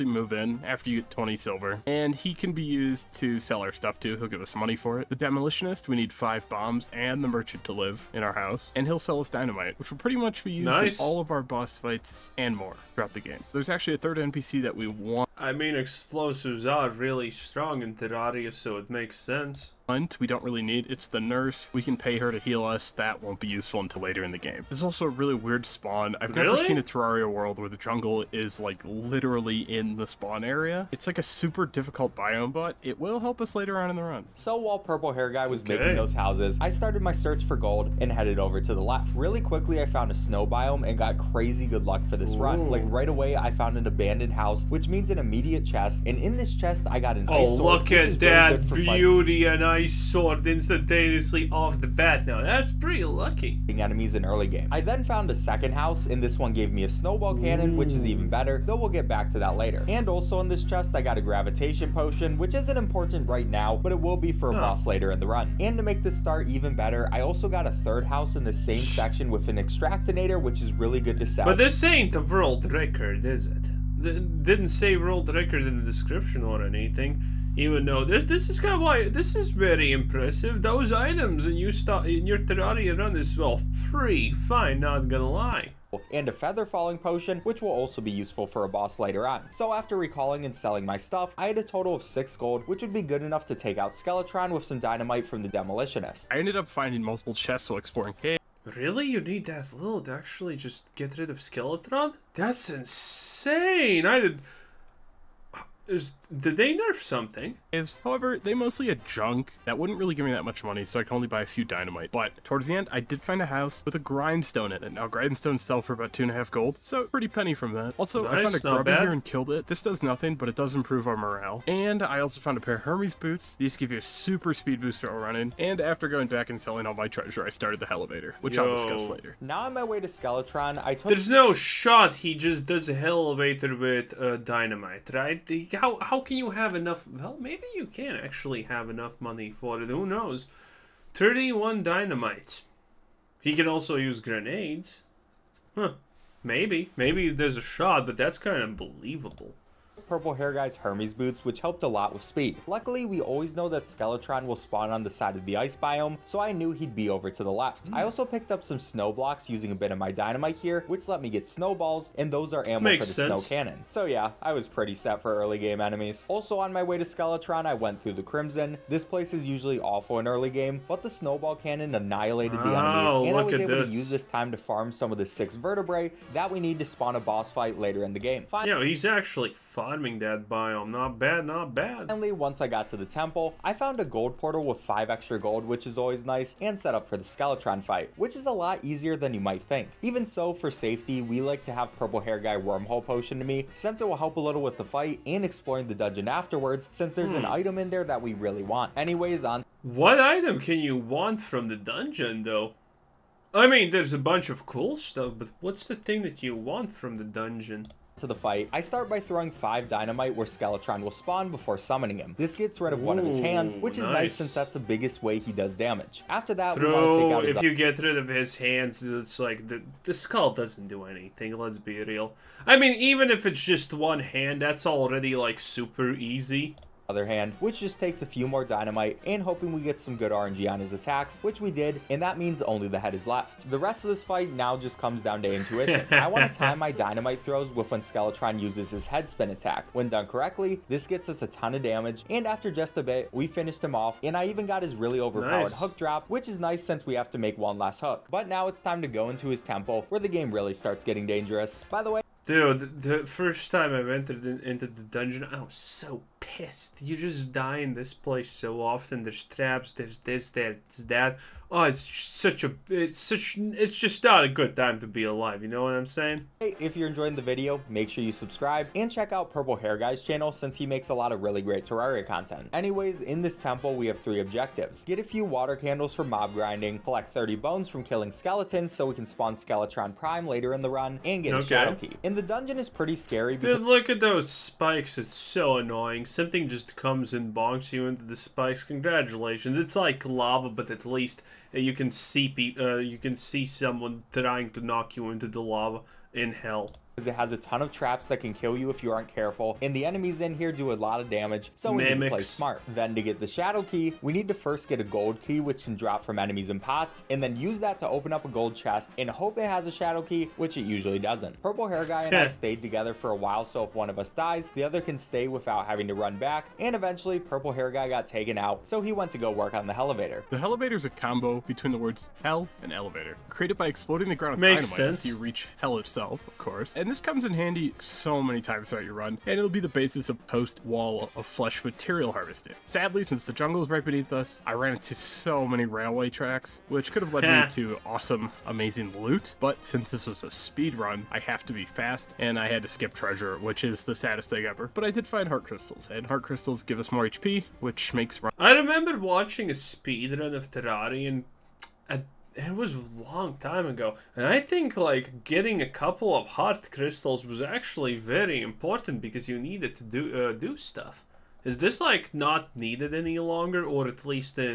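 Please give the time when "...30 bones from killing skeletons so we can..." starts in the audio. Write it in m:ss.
4:37.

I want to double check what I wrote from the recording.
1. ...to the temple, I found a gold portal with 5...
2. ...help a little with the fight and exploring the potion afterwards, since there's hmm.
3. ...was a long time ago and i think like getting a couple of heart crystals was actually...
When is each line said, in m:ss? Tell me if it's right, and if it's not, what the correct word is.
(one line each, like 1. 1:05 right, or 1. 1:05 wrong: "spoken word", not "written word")
1. 3:02 right
2. 3:14 wrong: "dungeon", not "potion"
3. 5:52 right.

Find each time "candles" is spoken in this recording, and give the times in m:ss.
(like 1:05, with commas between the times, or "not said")
4:35.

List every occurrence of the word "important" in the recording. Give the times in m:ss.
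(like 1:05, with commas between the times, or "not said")
1:02, 5:58.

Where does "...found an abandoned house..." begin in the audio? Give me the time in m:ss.
0:43.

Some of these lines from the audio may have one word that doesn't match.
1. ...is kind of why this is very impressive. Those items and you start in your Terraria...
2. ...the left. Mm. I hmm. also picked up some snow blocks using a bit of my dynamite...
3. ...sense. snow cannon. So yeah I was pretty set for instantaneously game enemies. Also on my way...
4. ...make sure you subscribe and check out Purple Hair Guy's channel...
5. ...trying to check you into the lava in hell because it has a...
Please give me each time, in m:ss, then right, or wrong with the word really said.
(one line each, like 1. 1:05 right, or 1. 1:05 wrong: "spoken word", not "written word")
1. 1:18 right
2. 2:37 right
3. 2:43 wrong: "early", not "instantaneously"
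4. 4:27 right
5. 4:54 wrong: "knock", not "check".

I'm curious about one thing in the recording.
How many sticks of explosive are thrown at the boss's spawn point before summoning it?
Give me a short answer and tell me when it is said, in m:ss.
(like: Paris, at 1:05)
5, at 3:29.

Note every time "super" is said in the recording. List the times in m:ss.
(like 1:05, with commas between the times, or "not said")
0:31, 2:04, 3:45.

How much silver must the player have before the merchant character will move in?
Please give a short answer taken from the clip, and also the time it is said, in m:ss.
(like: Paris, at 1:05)
20 silver, at 0:01.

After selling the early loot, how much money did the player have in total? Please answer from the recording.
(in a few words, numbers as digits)
6 gold.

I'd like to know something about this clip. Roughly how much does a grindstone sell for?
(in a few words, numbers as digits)
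two and a half gold.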